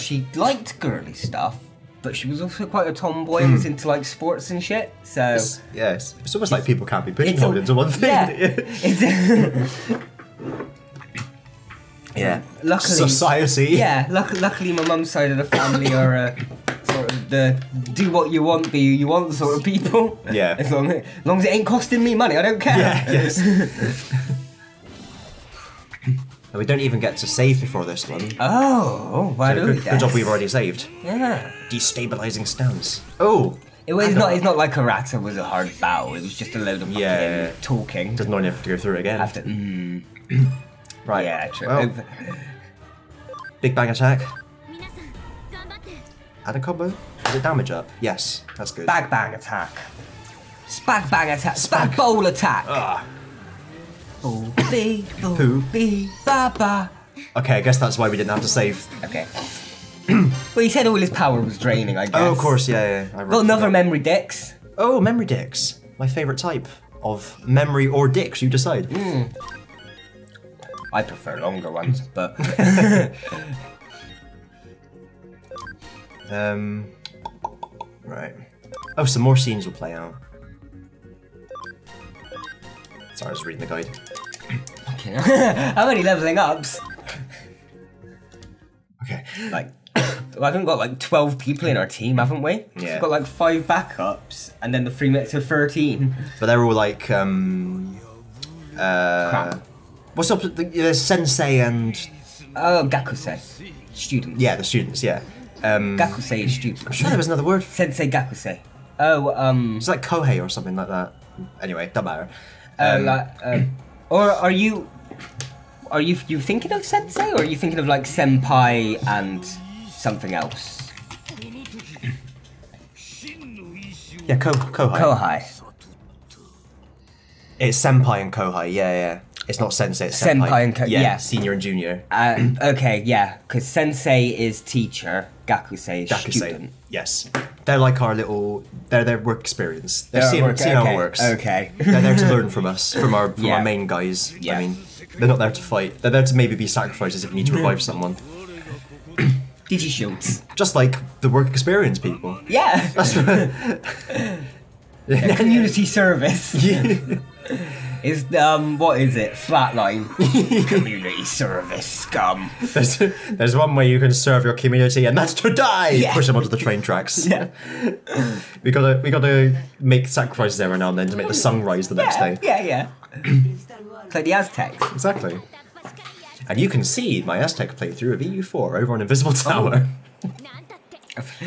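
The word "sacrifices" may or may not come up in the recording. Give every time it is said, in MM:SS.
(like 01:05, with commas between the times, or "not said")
02:26, 02:50.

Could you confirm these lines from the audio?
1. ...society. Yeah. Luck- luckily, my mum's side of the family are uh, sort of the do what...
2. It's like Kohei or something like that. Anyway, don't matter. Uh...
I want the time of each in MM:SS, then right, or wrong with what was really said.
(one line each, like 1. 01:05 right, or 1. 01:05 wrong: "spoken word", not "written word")
1. 00:12 right
2. 01:49 right.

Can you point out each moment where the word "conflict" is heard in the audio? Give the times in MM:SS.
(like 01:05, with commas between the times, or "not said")
not said.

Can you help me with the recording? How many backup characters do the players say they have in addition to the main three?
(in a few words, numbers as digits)
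5.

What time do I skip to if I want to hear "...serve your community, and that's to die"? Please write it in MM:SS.
02:44.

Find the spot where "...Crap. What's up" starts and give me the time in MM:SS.
01:39.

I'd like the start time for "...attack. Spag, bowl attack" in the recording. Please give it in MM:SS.
00:51.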